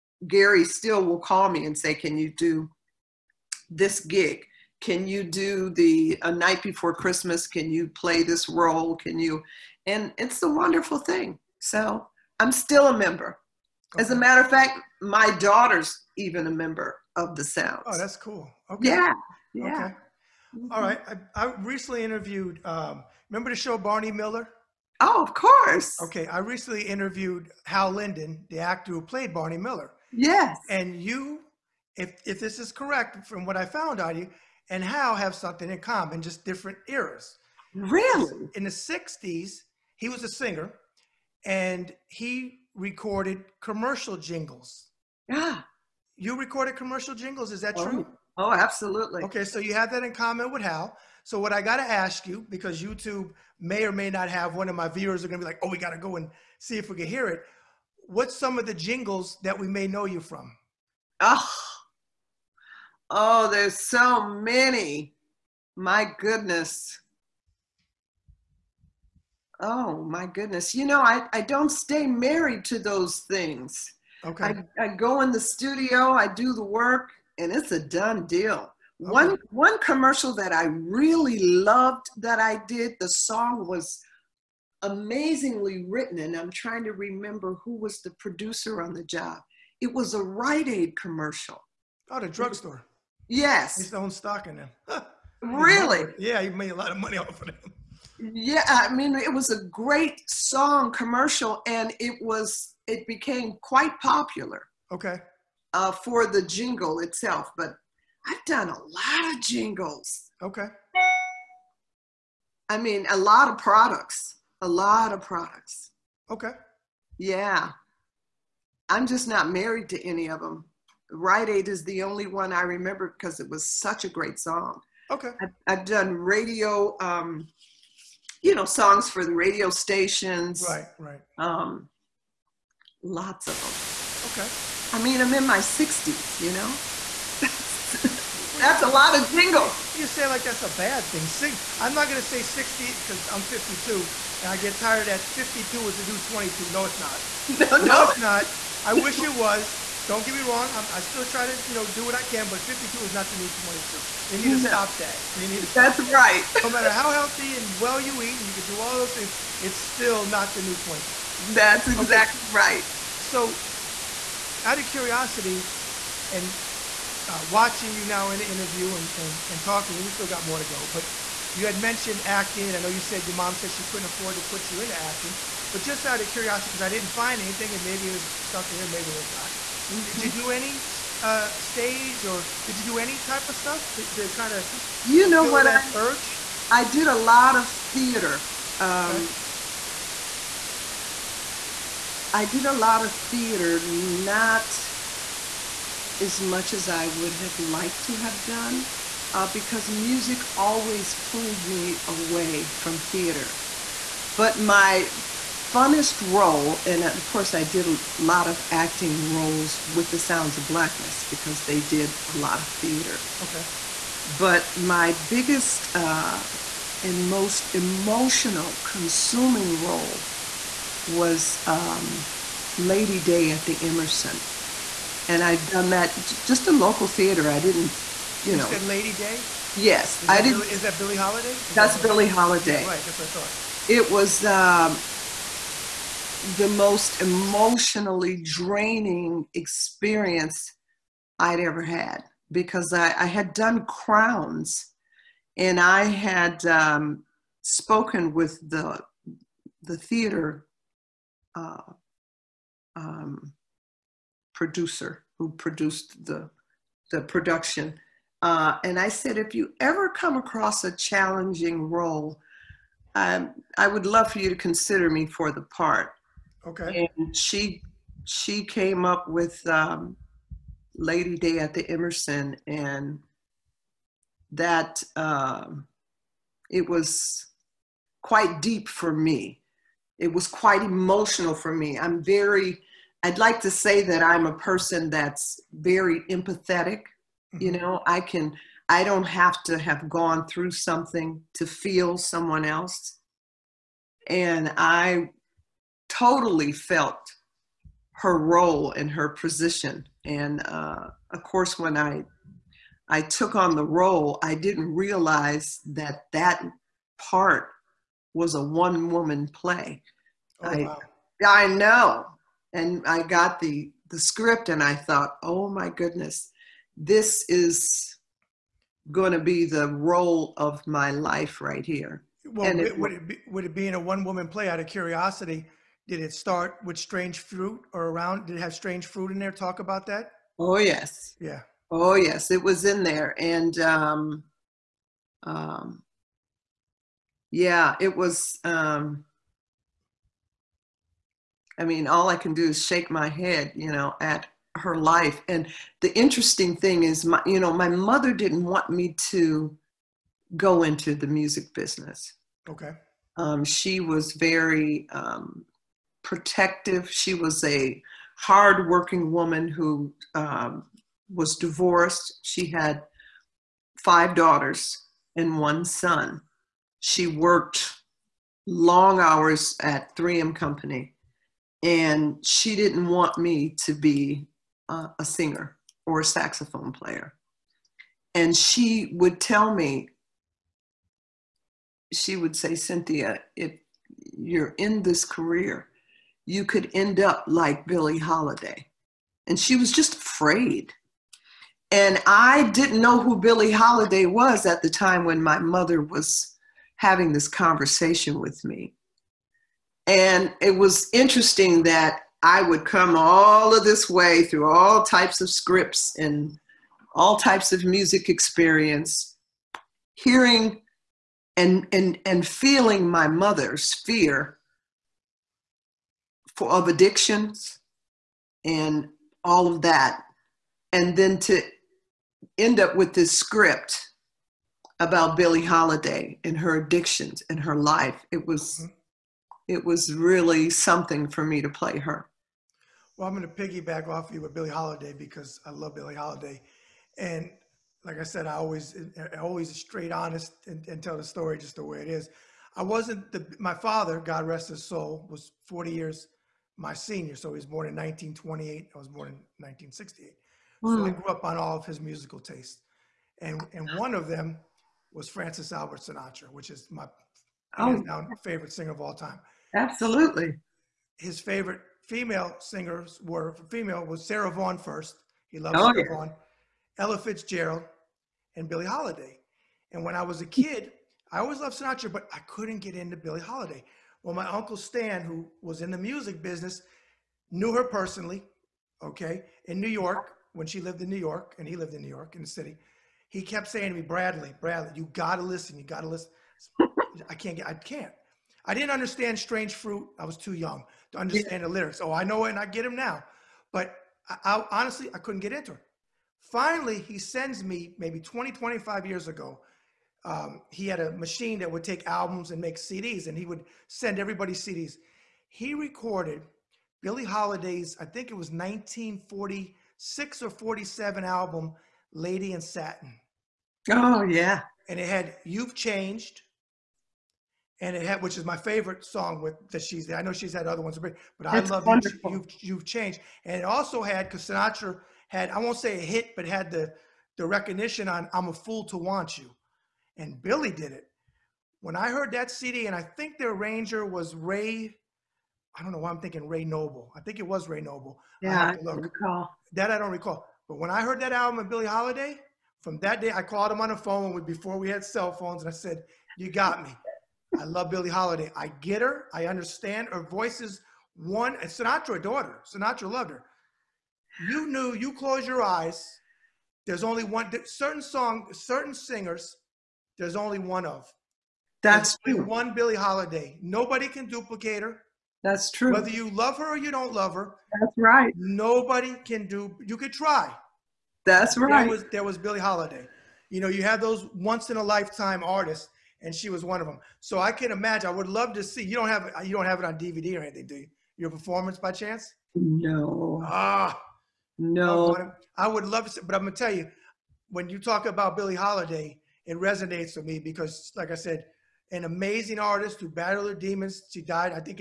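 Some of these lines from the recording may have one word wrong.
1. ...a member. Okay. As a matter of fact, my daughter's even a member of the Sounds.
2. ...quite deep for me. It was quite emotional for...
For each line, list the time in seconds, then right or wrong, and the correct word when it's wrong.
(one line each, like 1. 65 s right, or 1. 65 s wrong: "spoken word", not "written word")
1. 12 s right
2. 278 s right.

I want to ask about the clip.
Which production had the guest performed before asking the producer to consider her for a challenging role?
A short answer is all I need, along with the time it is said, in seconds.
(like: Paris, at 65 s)
Crowns, at 243 s.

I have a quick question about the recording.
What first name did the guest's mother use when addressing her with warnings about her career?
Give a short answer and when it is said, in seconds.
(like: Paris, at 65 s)
Cynthia, at 382 s.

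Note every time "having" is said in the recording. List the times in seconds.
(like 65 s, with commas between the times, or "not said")
396 s.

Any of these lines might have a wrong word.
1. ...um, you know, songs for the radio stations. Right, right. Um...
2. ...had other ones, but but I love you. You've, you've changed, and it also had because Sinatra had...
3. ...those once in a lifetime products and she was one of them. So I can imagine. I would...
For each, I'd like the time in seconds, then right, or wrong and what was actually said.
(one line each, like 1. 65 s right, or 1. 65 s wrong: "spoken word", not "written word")
1. 127 s right
2. 520 s right
3. 574 s wrong: "artists", not "products".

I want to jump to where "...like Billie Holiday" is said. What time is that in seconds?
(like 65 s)
387 s.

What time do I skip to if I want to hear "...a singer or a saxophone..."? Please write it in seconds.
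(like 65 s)
375 s.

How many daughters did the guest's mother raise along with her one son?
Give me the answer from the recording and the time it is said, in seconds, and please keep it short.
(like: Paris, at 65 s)
5, at 363 s.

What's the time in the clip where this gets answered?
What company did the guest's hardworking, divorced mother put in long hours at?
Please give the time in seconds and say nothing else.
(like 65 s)
370 s.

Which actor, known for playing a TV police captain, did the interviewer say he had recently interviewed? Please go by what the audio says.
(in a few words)
Hal Linden.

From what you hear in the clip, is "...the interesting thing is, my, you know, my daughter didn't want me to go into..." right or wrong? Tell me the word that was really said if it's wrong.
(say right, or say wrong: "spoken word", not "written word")
wrong: "mother", not "daughter".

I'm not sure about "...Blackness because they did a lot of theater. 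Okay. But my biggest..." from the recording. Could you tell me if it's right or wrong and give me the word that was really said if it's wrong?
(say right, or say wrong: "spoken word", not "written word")
right.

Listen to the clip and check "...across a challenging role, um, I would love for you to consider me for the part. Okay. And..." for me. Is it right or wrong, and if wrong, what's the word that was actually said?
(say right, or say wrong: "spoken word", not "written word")
right.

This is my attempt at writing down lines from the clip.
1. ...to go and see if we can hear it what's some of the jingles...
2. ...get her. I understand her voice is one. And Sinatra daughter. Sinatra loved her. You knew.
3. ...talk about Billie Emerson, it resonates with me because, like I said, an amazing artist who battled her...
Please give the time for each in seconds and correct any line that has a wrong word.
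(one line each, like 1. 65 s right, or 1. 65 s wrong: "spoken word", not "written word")
1. 55 s right
2. 548 s right
3. 587 s wrong: "Holiday", not "Emerson".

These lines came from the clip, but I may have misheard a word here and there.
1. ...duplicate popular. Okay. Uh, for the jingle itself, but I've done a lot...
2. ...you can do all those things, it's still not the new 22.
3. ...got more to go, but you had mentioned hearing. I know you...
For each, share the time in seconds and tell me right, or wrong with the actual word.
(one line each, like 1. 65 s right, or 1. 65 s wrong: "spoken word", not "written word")
1. 103 s wrong: "quite", not "duplicate"
2. 158 s right
3. 170 s wrong: "acting", not "hearing".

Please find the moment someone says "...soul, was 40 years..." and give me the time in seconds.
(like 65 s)
444 s.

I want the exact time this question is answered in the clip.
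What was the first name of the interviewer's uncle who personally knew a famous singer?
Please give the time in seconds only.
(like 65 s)
474 s.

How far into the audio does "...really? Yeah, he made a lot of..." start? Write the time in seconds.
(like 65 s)
95 s.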